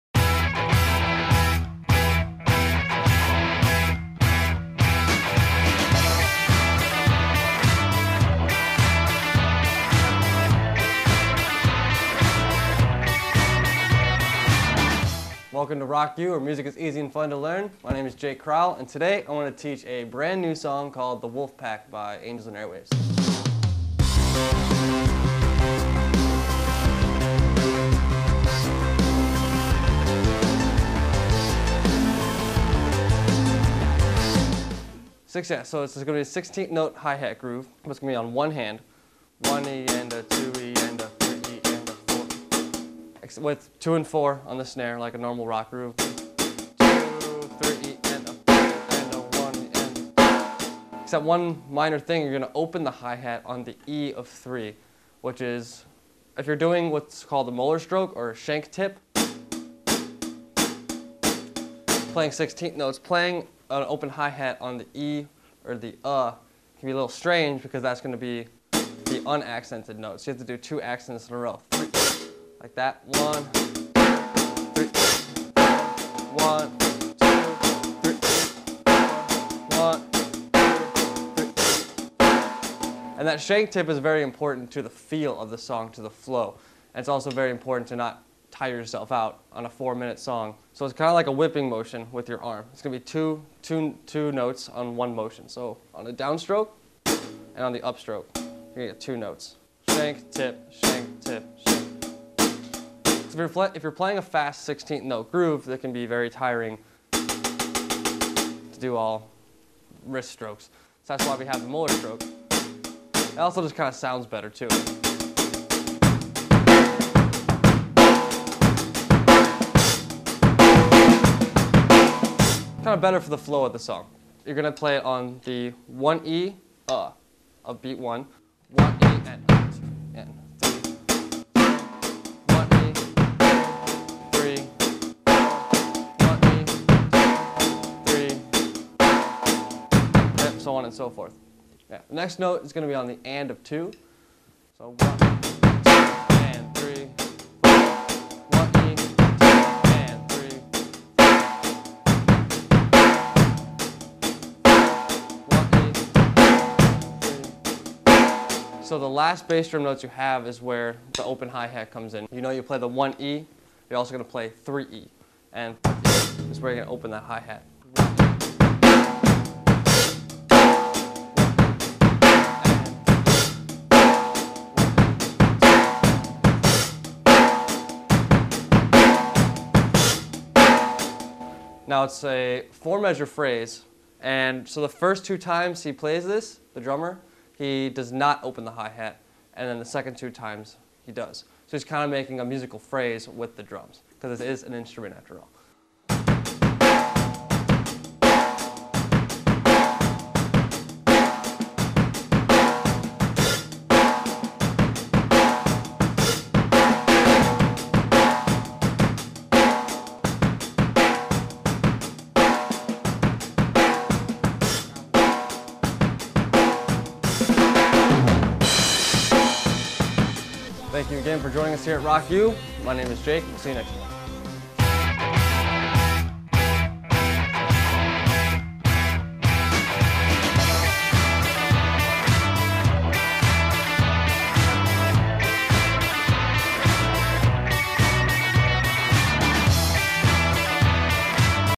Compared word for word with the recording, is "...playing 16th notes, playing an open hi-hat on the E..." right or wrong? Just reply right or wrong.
right.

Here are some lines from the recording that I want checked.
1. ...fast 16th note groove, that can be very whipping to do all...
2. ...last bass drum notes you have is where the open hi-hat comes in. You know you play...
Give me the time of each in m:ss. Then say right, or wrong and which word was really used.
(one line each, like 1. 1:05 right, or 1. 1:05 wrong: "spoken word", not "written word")
1. 1:44 wrong: "tiring", not "whipping"
2. 2:39 right.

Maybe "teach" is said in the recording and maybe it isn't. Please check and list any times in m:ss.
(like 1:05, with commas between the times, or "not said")
0:19.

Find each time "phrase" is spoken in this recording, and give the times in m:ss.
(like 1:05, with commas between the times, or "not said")
3:03, 3:12.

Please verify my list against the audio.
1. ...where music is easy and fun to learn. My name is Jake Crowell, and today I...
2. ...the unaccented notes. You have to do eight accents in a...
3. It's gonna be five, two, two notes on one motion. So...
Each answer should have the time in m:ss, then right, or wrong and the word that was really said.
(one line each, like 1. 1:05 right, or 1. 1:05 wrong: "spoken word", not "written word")
1. 0:16 right
2. 1:08 wrong: "two", not "eight"
3. 1:32 wrong: "two", not "five".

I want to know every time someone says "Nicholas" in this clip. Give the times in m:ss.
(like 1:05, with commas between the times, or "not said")
not said.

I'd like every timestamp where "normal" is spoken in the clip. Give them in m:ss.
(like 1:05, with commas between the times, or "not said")
0:45.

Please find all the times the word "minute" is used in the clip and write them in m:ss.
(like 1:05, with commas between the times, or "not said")
1:29.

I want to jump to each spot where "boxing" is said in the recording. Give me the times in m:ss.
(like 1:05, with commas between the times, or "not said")
not said.